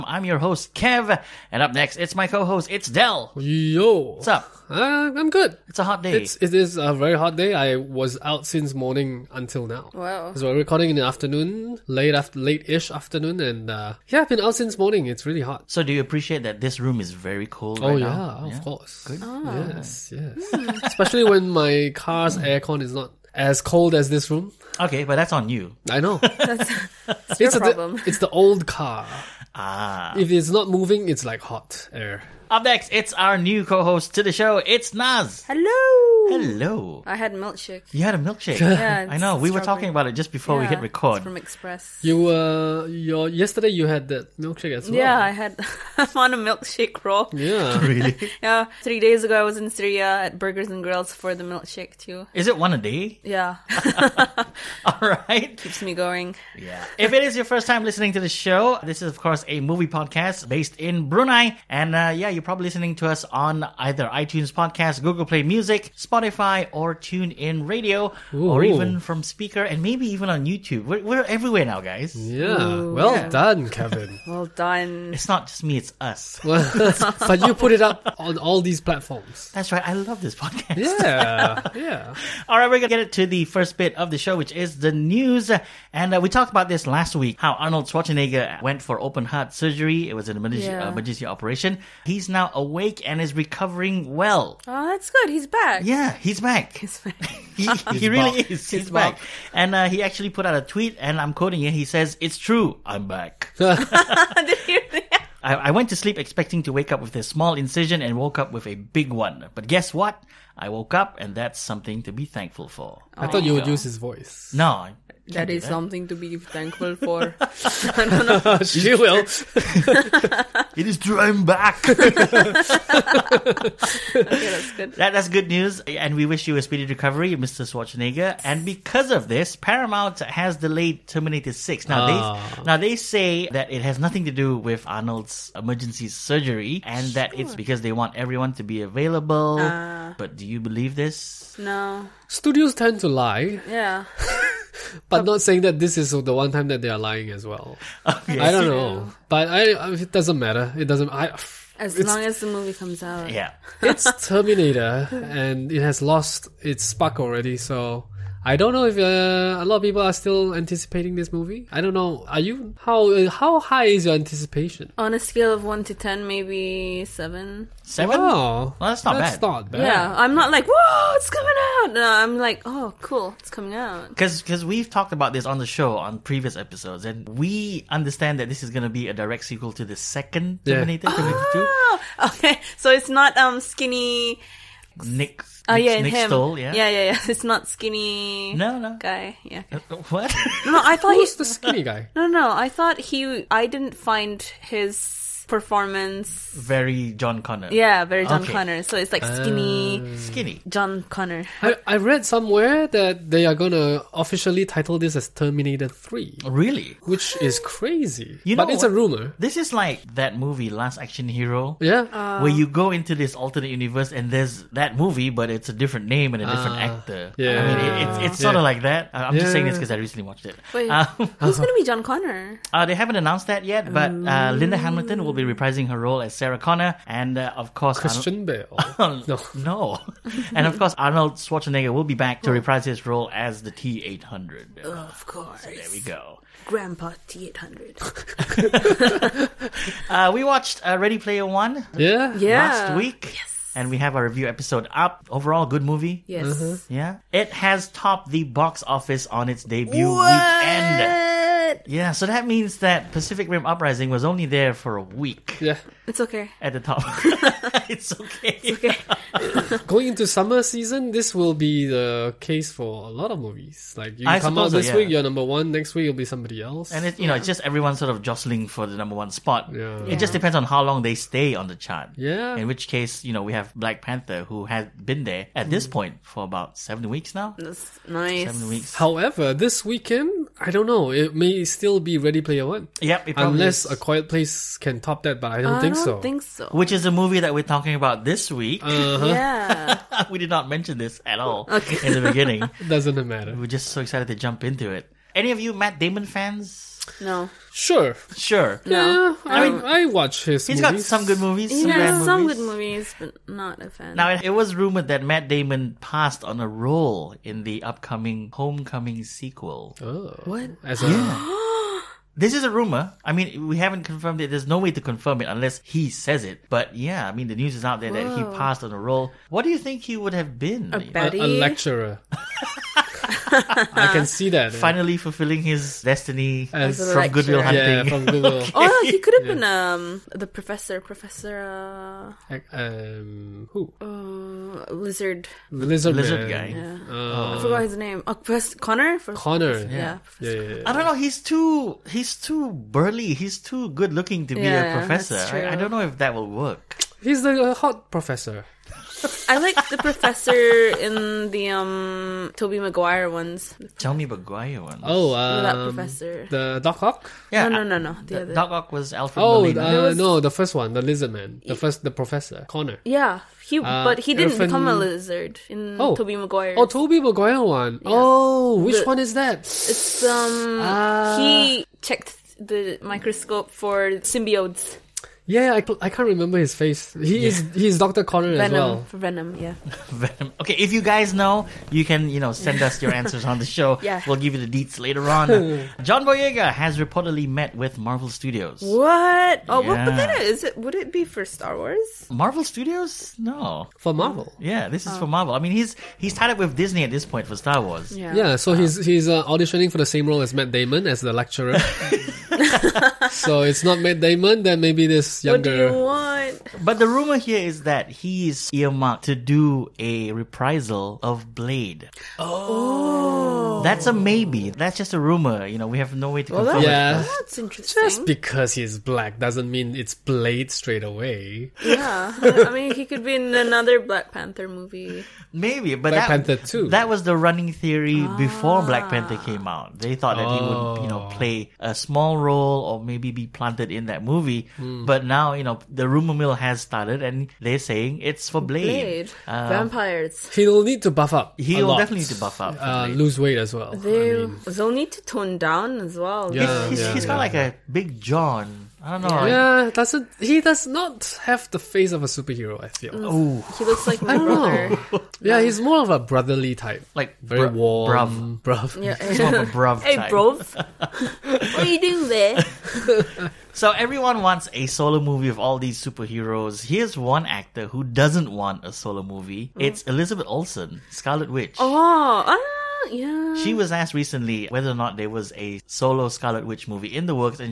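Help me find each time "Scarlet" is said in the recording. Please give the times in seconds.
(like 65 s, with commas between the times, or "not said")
471 s, 476 s.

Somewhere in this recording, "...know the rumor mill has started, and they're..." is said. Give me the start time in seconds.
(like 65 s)
435 s.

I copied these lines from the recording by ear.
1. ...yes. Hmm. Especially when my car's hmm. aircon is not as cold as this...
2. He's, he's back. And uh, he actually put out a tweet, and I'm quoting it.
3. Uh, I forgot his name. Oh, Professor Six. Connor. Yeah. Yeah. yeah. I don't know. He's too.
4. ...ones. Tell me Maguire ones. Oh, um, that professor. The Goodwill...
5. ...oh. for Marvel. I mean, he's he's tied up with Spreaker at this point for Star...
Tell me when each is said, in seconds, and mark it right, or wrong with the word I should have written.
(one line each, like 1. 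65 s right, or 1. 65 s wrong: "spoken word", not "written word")
1. 20 s right
2. 98 s right
3. 337 s wrong: "Connor", not "Six"
4. 353 s wrong: "Doc", not "Goodwill"
5. 395 s wrong: "Disney", not "Spreaker".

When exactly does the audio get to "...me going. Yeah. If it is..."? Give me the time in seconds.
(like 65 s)
55 s.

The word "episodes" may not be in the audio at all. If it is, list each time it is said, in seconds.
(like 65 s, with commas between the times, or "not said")
176 s, 244 s.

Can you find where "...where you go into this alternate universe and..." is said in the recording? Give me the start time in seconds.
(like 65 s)
212 s.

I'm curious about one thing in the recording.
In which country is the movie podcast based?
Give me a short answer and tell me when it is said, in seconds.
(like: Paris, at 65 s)
Brunei, at 61 s.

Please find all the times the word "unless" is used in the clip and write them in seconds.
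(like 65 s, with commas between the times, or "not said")
283 s, 315 s.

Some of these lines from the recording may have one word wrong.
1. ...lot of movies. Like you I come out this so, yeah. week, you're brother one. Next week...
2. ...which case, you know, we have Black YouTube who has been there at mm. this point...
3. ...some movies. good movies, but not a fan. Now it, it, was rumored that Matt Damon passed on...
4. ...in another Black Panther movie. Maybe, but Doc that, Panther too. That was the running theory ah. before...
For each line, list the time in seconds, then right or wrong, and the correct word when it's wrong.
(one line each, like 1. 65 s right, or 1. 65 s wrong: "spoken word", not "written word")
1. 263 s wrong: "number", not "brother"
2. 272 s wrong: "Panther", not "YouTube"
3. 302 s right
4. 423 s wrong: "Black", not "Doc".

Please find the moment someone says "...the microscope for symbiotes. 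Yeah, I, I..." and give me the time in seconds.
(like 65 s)
372 s.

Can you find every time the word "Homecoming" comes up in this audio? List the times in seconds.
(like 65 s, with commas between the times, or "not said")
308 s.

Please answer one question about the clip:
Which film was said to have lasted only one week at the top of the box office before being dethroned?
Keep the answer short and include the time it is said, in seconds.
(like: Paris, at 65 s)
Pacific Rim Uprising, at 253 s.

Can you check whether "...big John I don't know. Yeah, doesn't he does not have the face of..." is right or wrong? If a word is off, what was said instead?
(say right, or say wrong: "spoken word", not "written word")
right.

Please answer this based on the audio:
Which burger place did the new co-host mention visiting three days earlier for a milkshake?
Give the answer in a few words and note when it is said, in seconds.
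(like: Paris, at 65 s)
Burgers and Grills, at 50 s.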